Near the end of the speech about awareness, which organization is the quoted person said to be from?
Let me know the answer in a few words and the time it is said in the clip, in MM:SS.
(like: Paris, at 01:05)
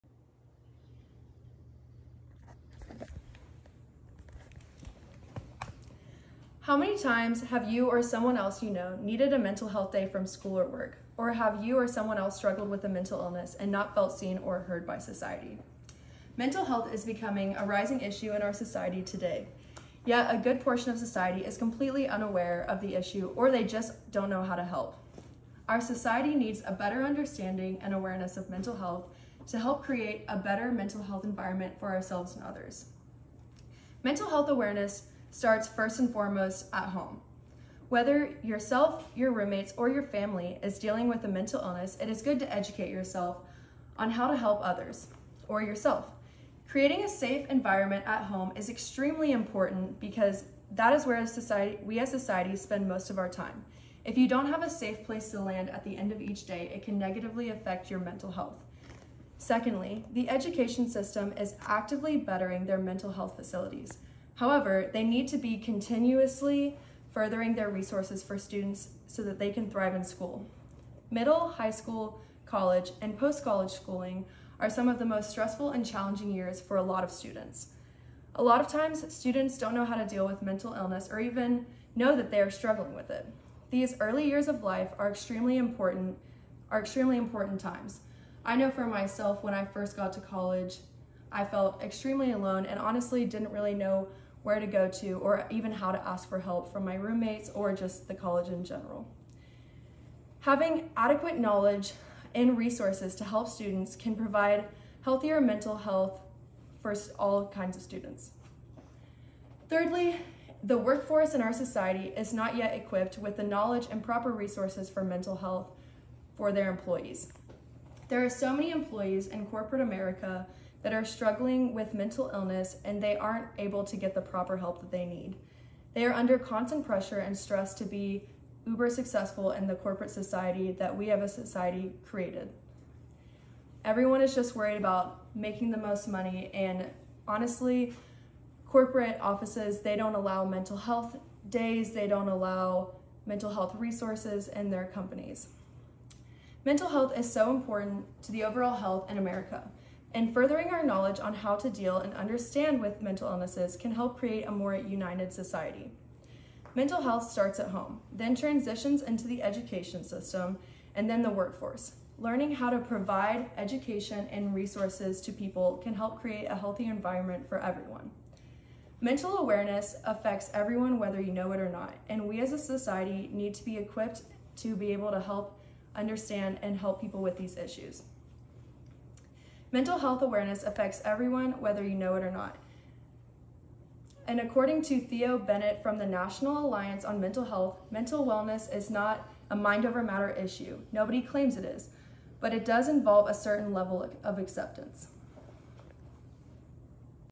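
National Alliance on Mental Health, at 03:06.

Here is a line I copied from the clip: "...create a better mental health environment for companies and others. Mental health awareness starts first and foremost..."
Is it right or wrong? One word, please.
wrong.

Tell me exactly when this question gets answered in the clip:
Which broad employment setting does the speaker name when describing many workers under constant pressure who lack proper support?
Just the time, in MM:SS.
01:59.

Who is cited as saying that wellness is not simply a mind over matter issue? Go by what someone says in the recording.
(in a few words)
Theo Bennett.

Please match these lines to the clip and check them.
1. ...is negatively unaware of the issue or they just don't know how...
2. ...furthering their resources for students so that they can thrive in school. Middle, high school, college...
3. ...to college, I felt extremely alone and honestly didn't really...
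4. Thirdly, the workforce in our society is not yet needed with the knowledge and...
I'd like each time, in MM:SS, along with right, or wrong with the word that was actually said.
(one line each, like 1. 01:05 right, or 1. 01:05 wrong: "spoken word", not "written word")
1. 00:21 wrong: "completely", not "negatively"
2. 01:07 right
3. 01:30 right
4. 01:49 wrong: "equipped", not "needed".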